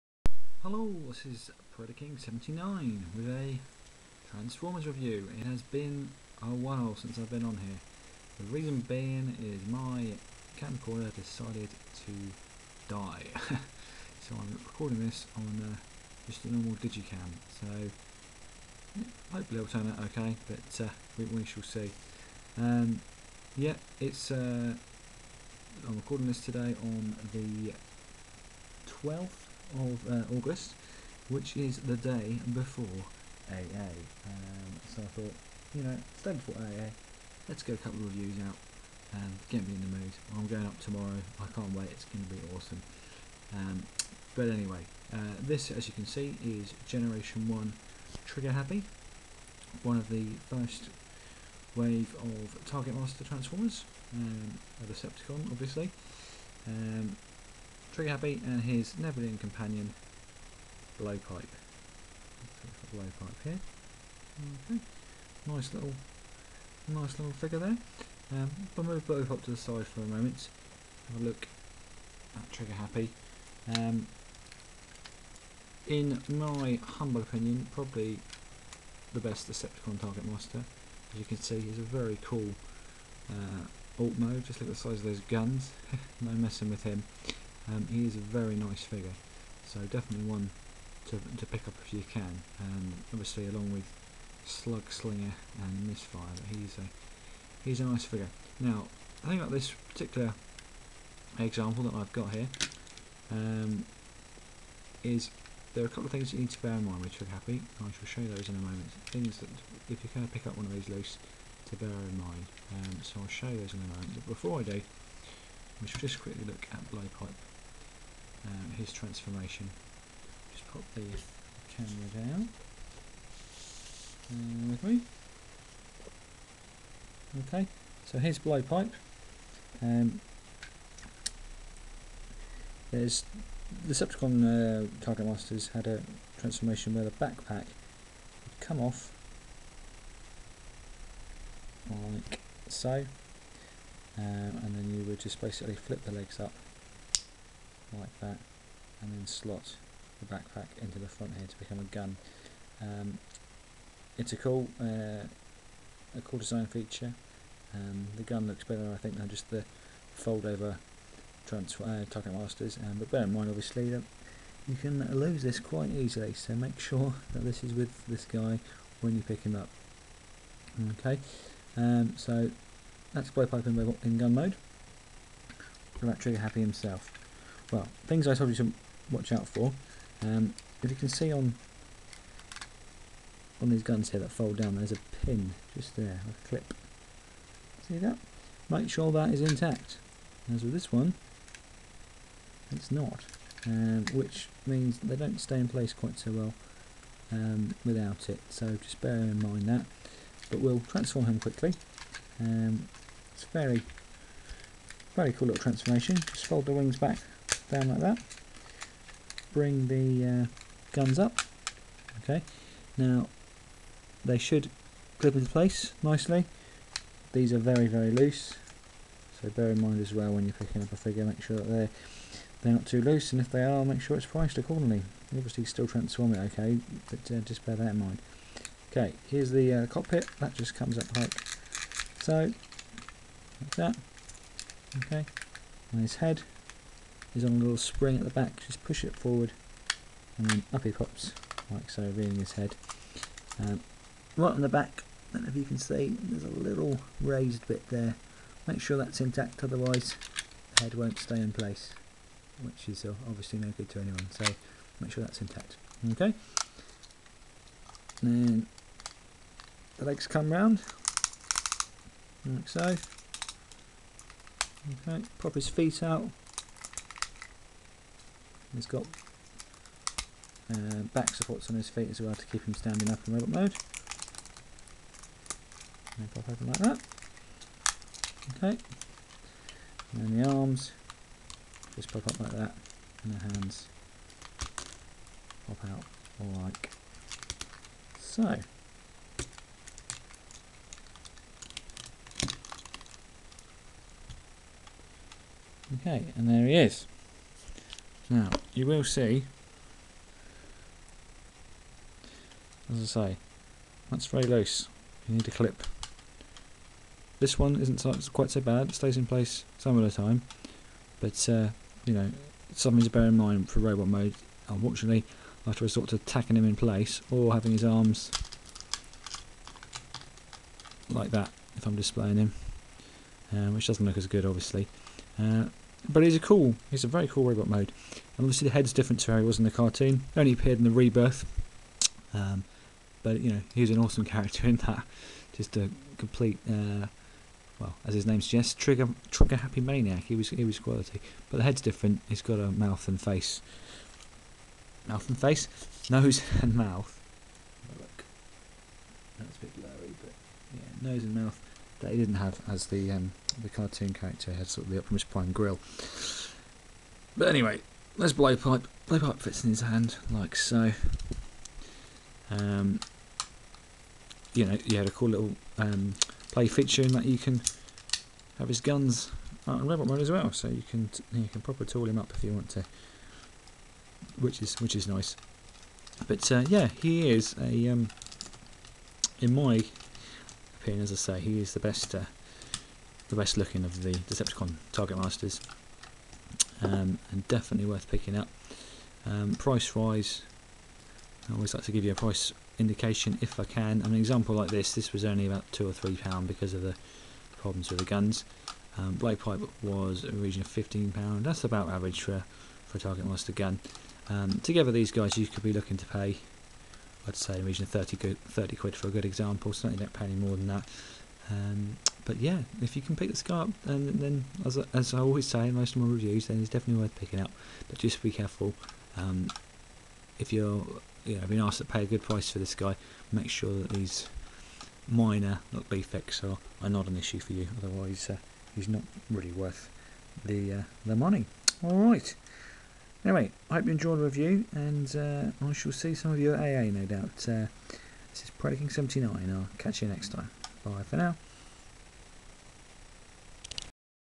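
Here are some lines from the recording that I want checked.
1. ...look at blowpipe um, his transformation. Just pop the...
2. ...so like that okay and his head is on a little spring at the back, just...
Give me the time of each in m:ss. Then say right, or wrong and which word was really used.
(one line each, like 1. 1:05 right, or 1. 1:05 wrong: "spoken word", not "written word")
1. 1:56 right
2. 3:52 right.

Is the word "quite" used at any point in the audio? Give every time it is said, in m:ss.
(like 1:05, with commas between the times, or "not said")
2:45, 3:15, 5:08.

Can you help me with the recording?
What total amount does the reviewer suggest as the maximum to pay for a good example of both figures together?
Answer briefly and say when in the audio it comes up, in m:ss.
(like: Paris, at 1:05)
30 quid, at 6:48.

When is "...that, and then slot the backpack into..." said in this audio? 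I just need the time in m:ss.
2:28.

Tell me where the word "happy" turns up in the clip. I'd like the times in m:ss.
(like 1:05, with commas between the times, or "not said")
0:48, 0:58, 1:12, 1:47, 2:56, 5:39, 6:20.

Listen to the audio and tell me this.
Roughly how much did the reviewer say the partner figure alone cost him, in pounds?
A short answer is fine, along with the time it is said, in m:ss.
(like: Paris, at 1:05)
15 pounds, at 6:40.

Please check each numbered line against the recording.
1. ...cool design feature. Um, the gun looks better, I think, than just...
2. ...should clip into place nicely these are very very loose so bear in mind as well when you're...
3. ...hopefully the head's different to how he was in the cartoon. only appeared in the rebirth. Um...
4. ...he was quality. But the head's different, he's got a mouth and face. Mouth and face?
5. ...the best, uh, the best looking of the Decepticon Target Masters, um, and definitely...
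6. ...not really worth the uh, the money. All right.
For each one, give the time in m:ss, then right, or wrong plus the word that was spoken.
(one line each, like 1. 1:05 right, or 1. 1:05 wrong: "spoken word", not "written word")
1. 2:36 right
2. 3:34 right
3. 5:28 wrong: "obviously", not "hopefully"
4. 5:40 right
5. 6:21 right
6. 7:08 right.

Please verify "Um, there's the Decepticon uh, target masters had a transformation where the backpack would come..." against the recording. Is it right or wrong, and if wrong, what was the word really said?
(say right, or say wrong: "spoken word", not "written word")
right.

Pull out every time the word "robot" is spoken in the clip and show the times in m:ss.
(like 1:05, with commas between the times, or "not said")
4:33, 5:13, 5:27, 6:09.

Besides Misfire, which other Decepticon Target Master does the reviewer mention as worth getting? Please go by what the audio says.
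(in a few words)
Slug Slinger.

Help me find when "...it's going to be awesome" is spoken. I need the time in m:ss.
0:41.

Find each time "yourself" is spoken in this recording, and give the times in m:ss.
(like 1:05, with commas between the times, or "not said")
not said.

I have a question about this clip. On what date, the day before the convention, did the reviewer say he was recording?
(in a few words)
12th of August.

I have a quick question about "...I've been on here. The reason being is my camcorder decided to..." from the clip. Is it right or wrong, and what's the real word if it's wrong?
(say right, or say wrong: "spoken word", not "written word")
right.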